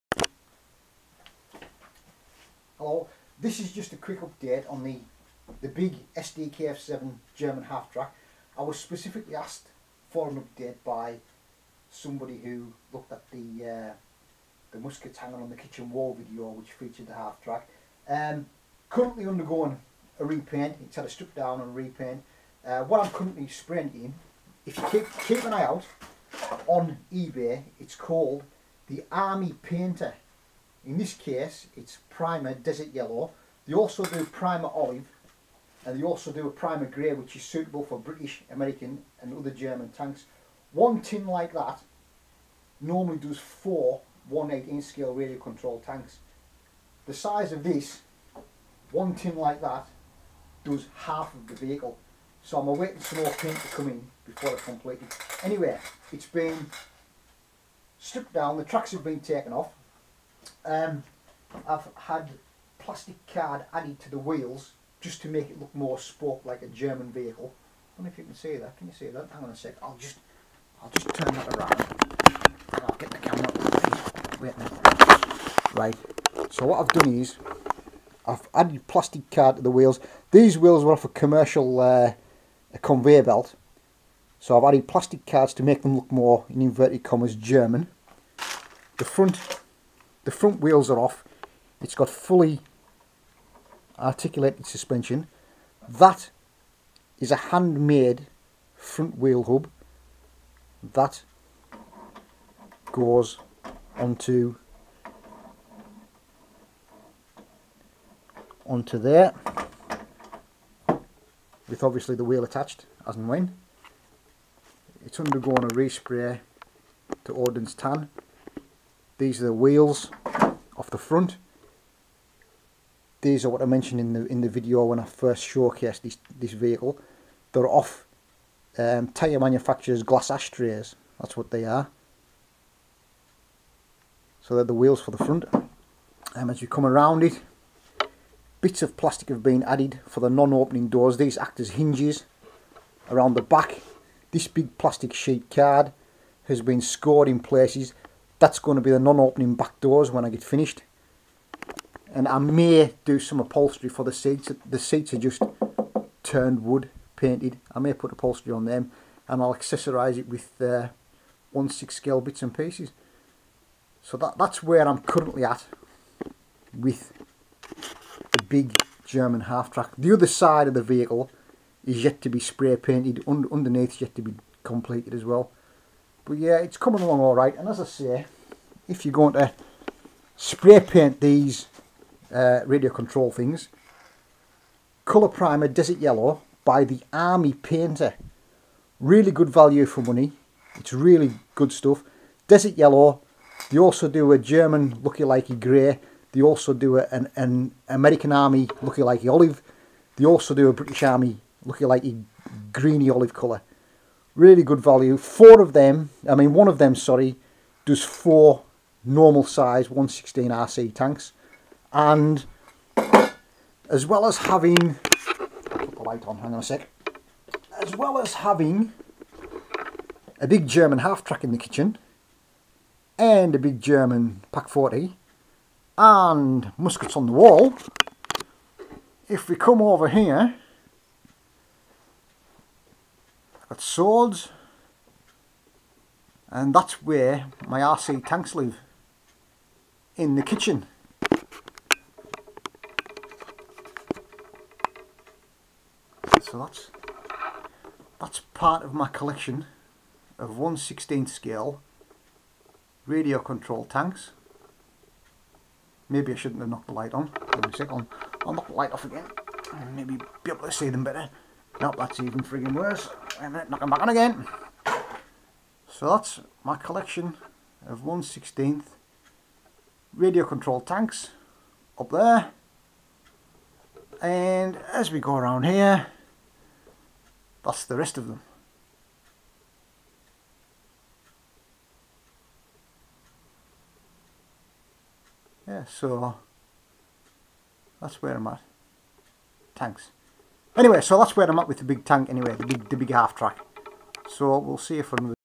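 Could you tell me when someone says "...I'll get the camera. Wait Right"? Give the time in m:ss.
1:12.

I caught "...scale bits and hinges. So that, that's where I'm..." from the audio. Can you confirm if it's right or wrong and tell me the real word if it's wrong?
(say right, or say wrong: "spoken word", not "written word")
wrong: "pieces", not "hinges".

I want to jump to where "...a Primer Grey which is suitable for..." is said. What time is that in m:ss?
0:36.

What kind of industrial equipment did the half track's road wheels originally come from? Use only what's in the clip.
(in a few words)
A conveyor belt.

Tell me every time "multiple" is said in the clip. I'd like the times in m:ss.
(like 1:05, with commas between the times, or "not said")
not said.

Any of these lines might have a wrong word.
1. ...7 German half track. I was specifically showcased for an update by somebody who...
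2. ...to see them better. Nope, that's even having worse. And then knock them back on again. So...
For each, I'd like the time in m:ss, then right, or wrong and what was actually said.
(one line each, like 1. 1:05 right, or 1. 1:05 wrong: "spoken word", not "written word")
1. 0:06 wrong: "asked", not "showcased"
2. 4:20 wrong: "frigging", not "having".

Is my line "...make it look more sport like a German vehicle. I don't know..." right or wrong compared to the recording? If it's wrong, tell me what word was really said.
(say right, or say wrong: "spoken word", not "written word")
right.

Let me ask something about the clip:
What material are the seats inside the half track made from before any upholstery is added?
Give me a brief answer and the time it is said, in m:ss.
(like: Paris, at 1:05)
Turned wood, at 2:36.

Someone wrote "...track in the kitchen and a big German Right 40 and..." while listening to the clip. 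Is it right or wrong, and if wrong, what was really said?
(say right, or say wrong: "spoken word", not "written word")
wrong: "Pak", not "Right".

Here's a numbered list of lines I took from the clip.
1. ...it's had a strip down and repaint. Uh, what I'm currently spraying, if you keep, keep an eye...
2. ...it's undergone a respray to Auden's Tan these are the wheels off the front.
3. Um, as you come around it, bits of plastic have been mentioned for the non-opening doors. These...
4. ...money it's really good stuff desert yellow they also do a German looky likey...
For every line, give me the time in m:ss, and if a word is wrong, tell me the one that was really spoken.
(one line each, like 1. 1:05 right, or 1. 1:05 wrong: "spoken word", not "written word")
1. 0:20 right
2. 1:55 right
3. 2:16 wrong: "added", not "mentioned"
4. 3:10 right.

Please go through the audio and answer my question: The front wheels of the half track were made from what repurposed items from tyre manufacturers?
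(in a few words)
Glass ashtrays.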